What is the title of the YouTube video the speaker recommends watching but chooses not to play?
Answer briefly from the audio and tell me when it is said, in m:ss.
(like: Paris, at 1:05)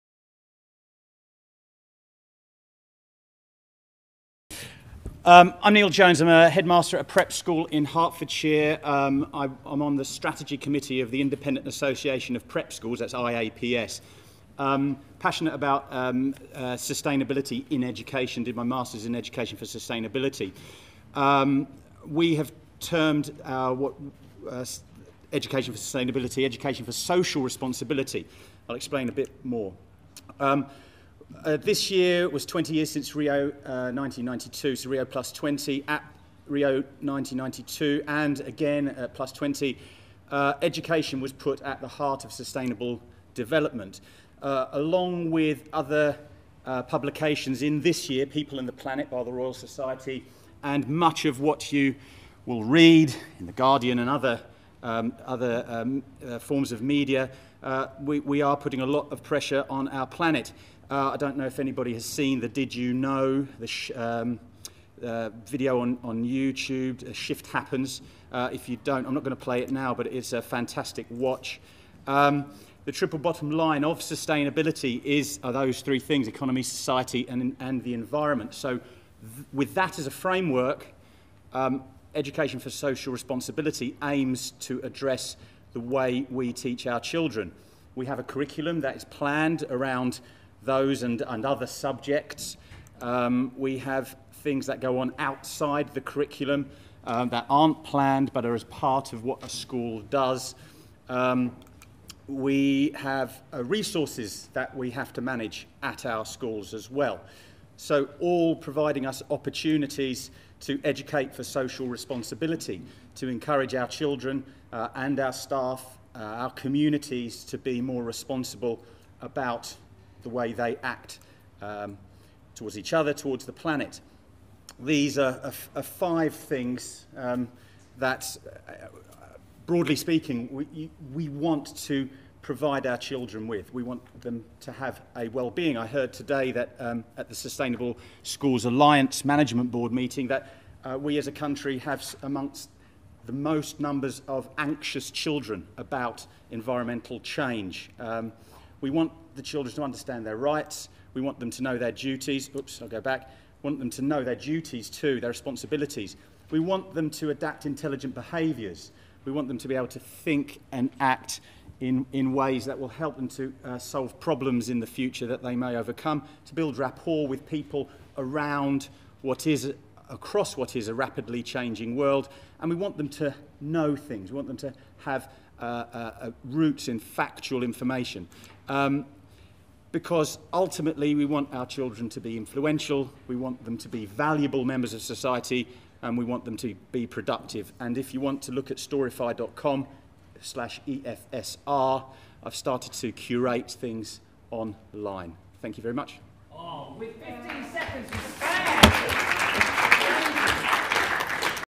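Did You Know, at 1:02.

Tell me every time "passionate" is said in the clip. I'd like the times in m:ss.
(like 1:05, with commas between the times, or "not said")
0:15.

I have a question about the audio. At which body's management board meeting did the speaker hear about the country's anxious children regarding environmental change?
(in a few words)
Sustainable Schools Alliance.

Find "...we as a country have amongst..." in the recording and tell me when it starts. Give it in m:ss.
2:20.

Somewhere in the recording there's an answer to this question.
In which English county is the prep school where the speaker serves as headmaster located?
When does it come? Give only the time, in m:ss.
0:07.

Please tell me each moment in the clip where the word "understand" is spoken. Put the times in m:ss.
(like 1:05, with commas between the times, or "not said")
2:29.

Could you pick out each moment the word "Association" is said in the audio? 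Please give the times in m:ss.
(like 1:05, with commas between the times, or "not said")
0:11.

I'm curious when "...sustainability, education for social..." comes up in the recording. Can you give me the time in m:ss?
0:25.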